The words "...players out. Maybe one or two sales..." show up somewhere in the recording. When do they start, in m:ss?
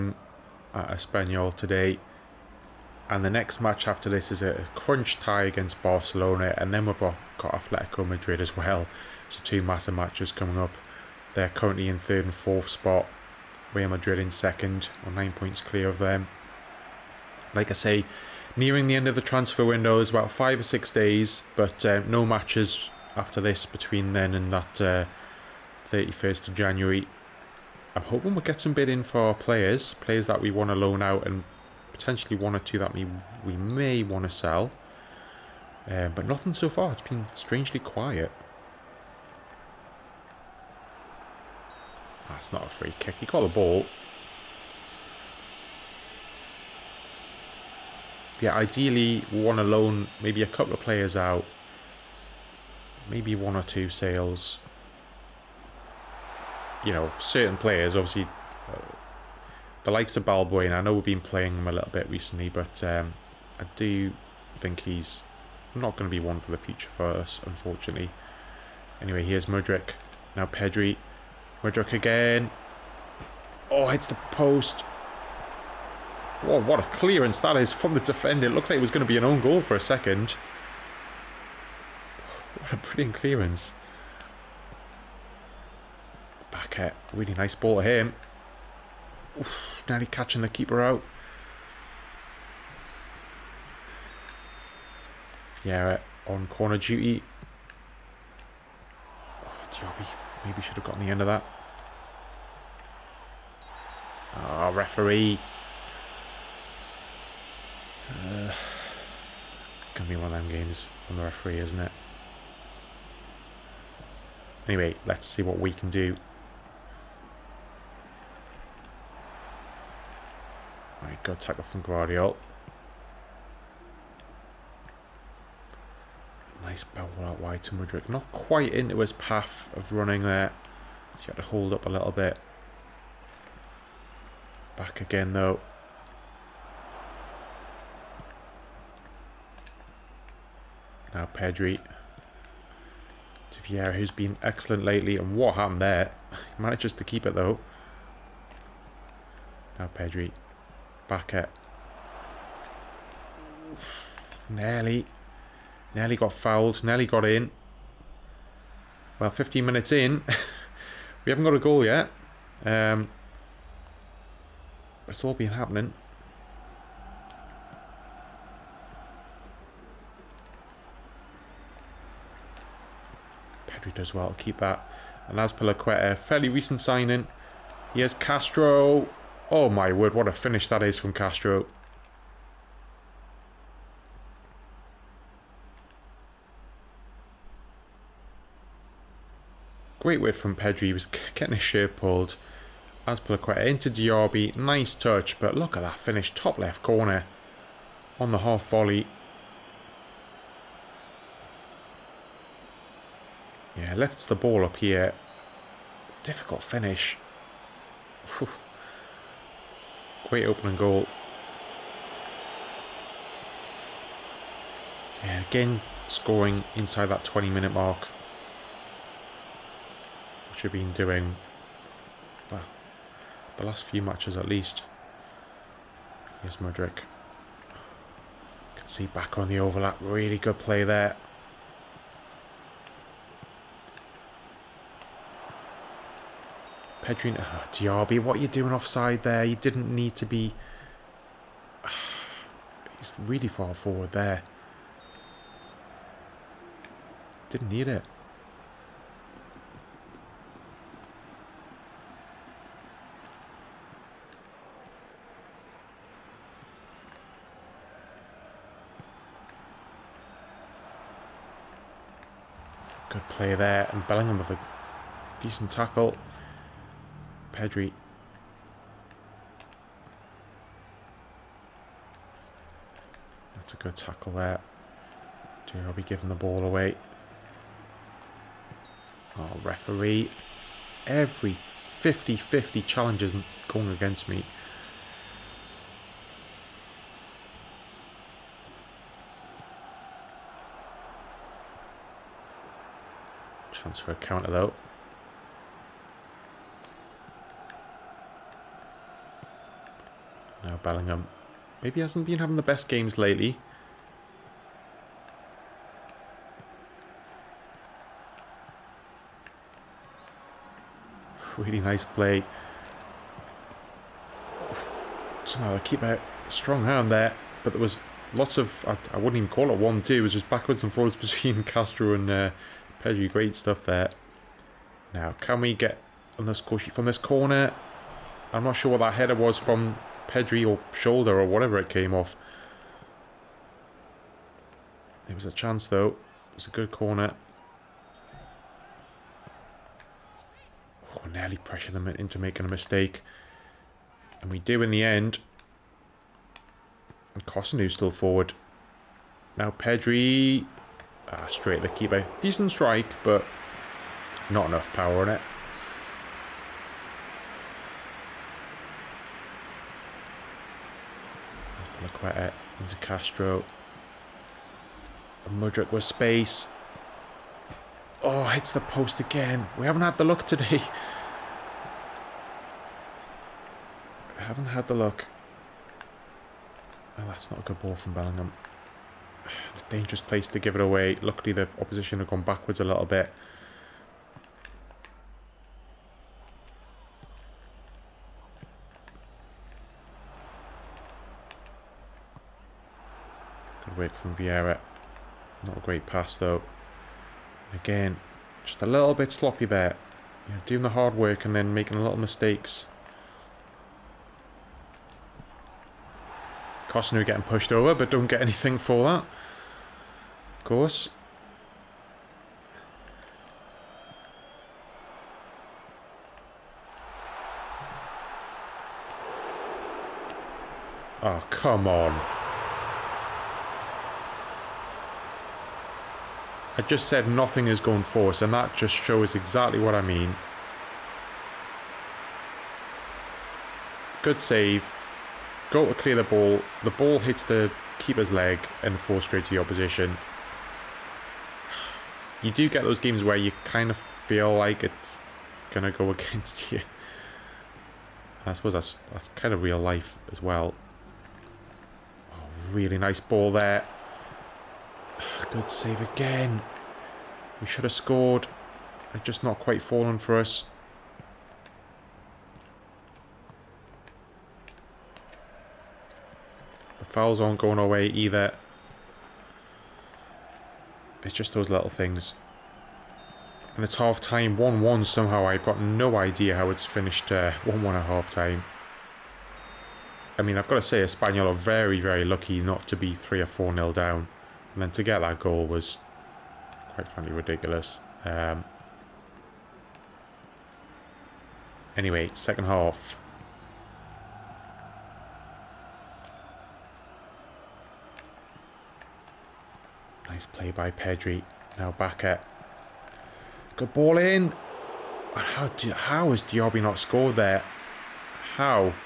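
0:50.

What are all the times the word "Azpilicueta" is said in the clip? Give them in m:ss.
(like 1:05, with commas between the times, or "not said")
2:55, 3:13.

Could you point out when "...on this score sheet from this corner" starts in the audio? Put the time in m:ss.
5:26.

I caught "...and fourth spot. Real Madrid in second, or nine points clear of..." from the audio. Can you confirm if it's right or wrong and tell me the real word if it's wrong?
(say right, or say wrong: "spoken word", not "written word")
right.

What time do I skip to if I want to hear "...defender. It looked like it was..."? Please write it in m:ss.
1:18.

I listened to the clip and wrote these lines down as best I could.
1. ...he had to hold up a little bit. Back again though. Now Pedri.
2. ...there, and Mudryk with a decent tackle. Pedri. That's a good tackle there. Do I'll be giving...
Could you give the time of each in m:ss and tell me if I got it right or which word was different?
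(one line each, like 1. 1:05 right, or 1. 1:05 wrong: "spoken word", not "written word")
1. 2:11 right
2. 4:23 wrong: "Bellingham", not "Mudryk".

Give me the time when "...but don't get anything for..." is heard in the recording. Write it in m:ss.
6:47.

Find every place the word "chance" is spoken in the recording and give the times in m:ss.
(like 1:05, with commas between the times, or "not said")
4:53, 5:35.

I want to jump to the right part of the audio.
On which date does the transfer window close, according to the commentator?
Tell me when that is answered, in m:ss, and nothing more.
0:25.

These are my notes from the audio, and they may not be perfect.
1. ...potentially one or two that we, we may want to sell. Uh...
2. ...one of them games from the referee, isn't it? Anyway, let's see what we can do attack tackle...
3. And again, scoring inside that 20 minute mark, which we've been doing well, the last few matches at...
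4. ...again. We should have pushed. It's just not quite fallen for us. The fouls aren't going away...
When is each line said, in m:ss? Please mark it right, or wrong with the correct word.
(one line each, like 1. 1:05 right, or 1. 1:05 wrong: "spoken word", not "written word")
1. 0:31 right
2. 1:50 right
3. 3:35 right
4. 7:36 wrong: "scored", not "pushed".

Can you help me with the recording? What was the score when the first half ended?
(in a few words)
1-1.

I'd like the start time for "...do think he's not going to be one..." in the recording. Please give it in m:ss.
1:03.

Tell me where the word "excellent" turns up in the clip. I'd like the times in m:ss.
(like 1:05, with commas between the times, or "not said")
2:24.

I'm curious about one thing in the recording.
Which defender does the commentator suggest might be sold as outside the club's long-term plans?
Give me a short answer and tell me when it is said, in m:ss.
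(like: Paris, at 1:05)
Balbuena, at 1:00.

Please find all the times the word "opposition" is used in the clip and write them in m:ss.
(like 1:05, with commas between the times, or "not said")
6:21, 7:19.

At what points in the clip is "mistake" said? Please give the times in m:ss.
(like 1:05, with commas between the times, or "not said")
5:42, 6:42.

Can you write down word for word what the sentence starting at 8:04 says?
And then to get that goal was, quite frankly, ridiculous.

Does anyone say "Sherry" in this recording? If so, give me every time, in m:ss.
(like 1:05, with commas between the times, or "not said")
not said.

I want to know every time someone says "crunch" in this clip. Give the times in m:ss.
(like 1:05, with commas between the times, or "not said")
0:04.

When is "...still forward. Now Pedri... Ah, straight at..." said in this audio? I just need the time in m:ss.
5:47.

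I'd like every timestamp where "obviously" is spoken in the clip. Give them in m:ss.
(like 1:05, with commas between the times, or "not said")
0:57.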